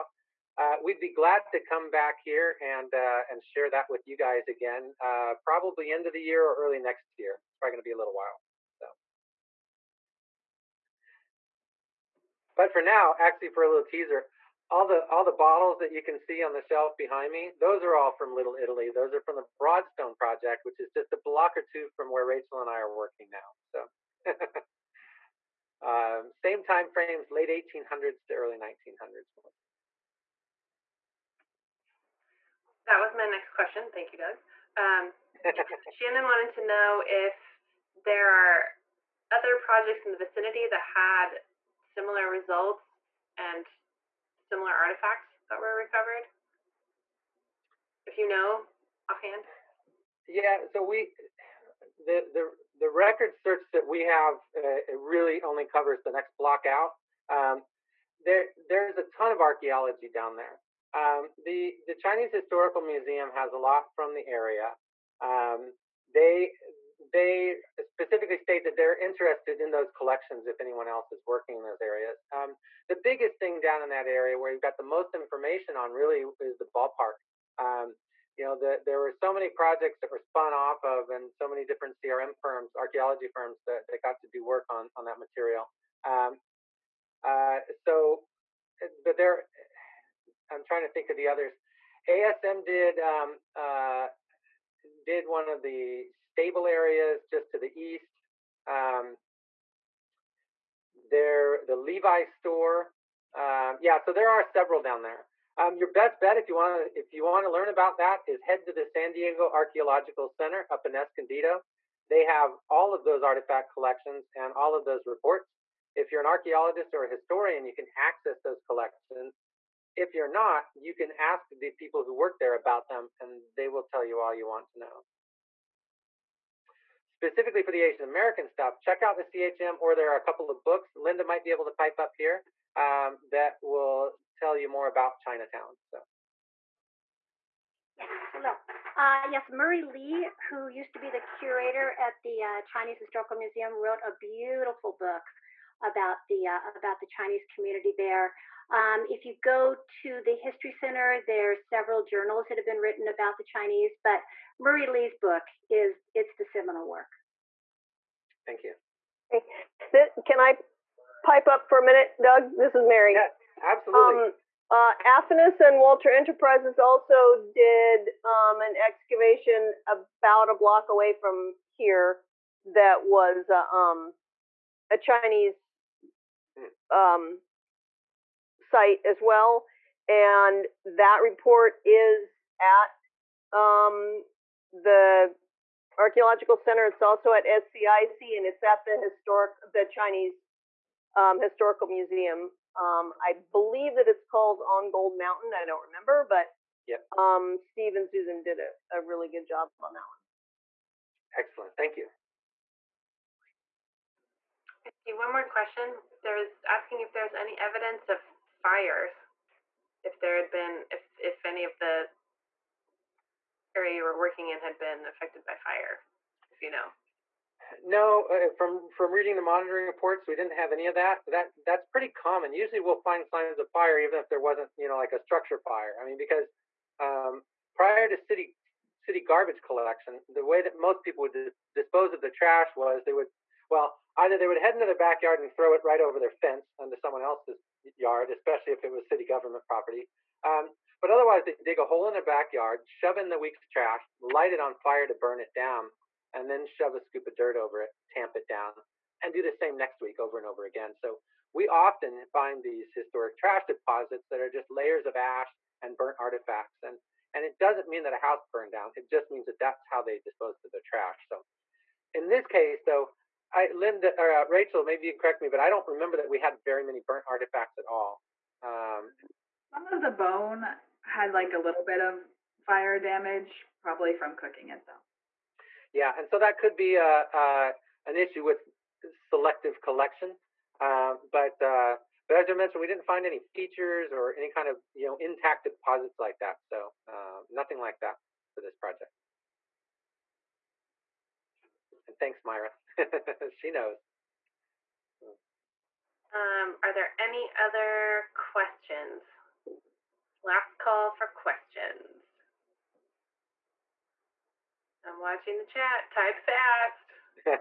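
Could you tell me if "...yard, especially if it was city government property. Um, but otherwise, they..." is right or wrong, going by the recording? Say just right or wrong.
right.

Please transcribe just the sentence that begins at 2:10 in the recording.
Linda might be able to pipe up here um, that will tell you more about Chinatown.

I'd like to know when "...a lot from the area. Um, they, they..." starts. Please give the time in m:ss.
1:03.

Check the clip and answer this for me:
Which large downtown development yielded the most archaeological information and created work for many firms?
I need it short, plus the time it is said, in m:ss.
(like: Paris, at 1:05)
the ballpark, at 1:16.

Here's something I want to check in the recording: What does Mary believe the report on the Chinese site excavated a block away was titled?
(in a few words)
On Gold Mountain.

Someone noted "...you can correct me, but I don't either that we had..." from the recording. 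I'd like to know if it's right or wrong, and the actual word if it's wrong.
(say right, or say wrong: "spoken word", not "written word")
wrong: "remember", not "either".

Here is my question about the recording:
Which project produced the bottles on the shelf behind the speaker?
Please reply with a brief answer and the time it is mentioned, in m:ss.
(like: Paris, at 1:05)
Broadstone project, at 0:19.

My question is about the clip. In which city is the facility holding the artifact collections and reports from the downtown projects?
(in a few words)
Escondido.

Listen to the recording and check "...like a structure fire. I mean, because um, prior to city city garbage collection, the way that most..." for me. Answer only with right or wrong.
right.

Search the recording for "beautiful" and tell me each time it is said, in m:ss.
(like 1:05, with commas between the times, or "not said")
2:24.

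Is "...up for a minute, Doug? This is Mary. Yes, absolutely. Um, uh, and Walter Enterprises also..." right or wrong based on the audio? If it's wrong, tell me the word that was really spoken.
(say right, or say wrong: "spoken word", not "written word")
right.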